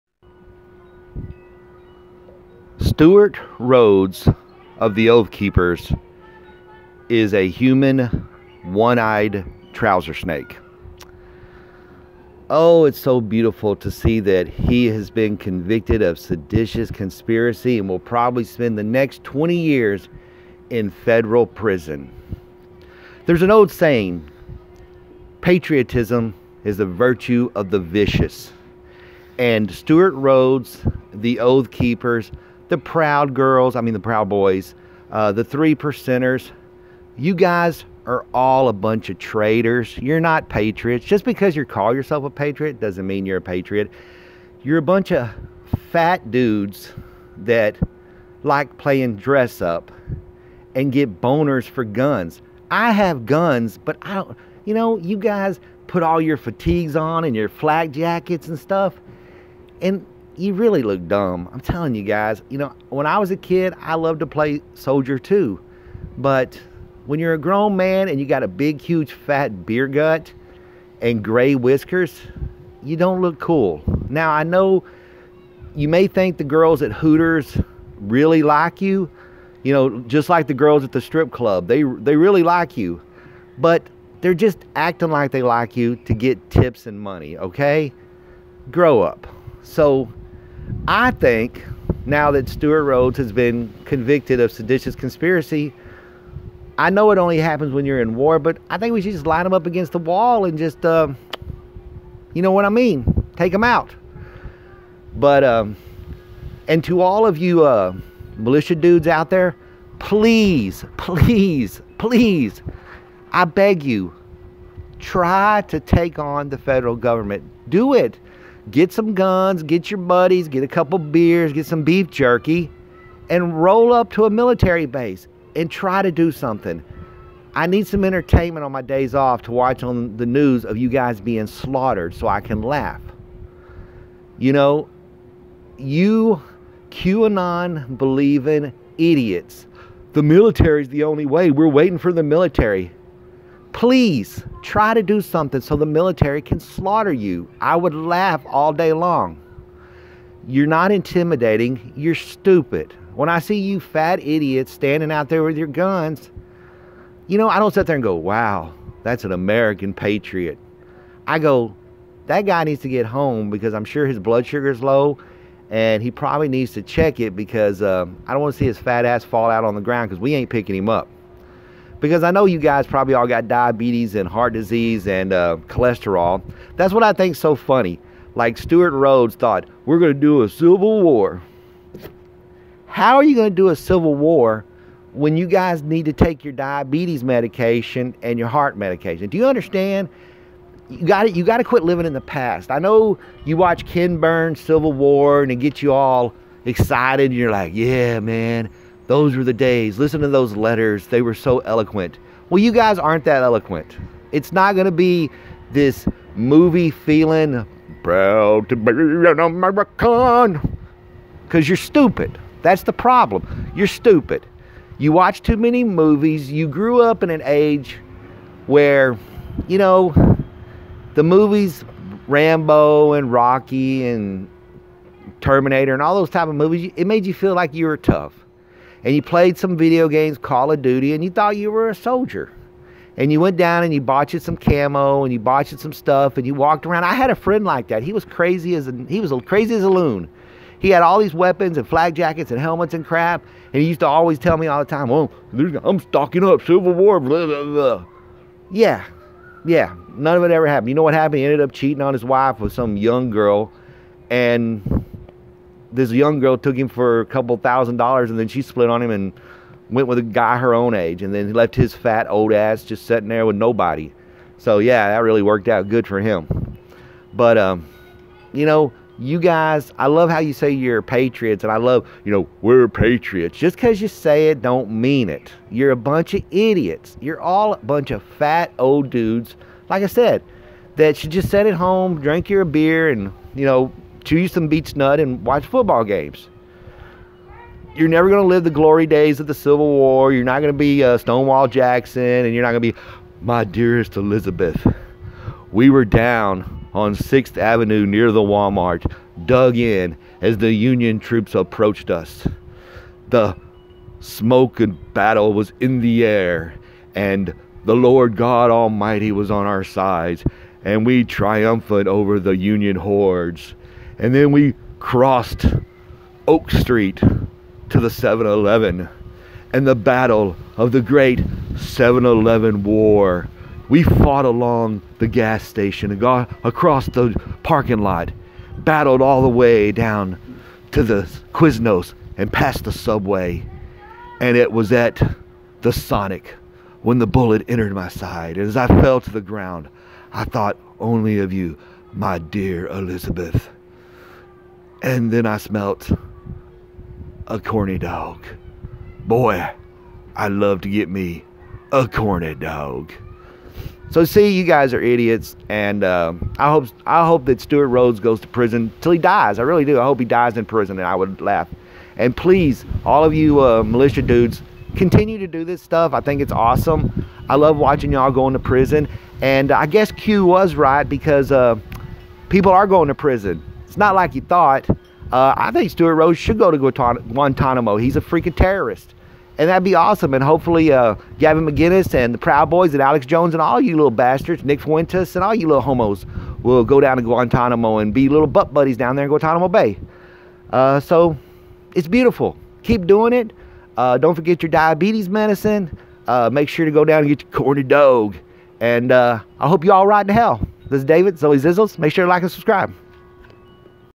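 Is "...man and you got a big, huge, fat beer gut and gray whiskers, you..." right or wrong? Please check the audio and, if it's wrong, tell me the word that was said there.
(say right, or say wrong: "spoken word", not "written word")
right.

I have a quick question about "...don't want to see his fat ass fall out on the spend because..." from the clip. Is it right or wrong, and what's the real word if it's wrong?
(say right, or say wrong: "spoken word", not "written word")
wrong: "ground", not "spend".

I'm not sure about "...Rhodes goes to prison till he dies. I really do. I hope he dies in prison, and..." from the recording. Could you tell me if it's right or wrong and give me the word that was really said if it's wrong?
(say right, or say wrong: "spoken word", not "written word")
right.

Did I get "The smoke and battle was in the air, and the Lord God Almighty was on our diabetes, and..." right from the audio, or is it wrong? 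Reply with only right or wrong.
wrong.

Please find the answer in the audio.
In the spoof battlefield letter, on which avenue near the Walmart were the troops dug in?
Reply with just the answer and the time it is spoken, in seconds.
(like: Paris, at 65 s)
6th Avenue, at 297 s.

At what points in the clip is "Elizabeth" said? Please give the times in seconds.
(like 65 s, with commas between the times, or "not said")
294 s, 342 s.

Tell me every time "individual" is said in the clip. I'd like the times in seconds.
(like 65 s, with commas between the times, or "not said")
not said.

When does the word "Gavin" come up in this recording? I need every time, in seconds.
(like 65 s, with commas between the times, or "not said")
381 s.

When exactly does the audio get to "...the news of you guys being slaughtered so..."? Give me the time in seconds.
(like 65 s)
130 s.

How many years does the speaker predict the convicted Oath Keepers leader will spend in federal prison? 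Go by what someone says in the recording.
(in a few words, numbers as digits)
20.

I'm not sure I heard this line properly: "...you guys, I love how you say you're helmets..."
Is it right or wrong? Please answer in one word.
wrong.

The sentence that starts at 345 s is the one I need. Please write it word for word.
And then I smelt a corny dog.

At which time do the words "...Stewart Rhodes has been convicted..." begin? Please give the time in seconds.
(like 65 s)
92 s.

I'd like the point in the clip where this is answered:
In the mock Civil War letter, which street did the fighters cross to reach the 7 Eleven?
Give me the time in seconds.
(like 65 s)
316 s.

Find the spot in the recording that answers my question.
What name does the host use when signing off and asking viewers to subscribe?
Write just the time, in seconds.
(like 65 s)
401 s.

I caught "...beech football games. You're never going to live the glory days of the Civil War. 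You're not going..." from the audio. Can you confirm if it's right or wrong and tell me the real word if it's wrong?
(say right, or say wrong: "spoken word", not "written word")
wrong: "watch", not "beech".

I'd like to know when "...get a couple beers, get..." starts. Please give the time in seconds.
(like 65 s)
120 s.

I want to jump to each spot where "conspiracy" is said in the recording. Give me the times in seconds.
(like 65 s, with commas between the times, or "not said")
16 s, 94 s.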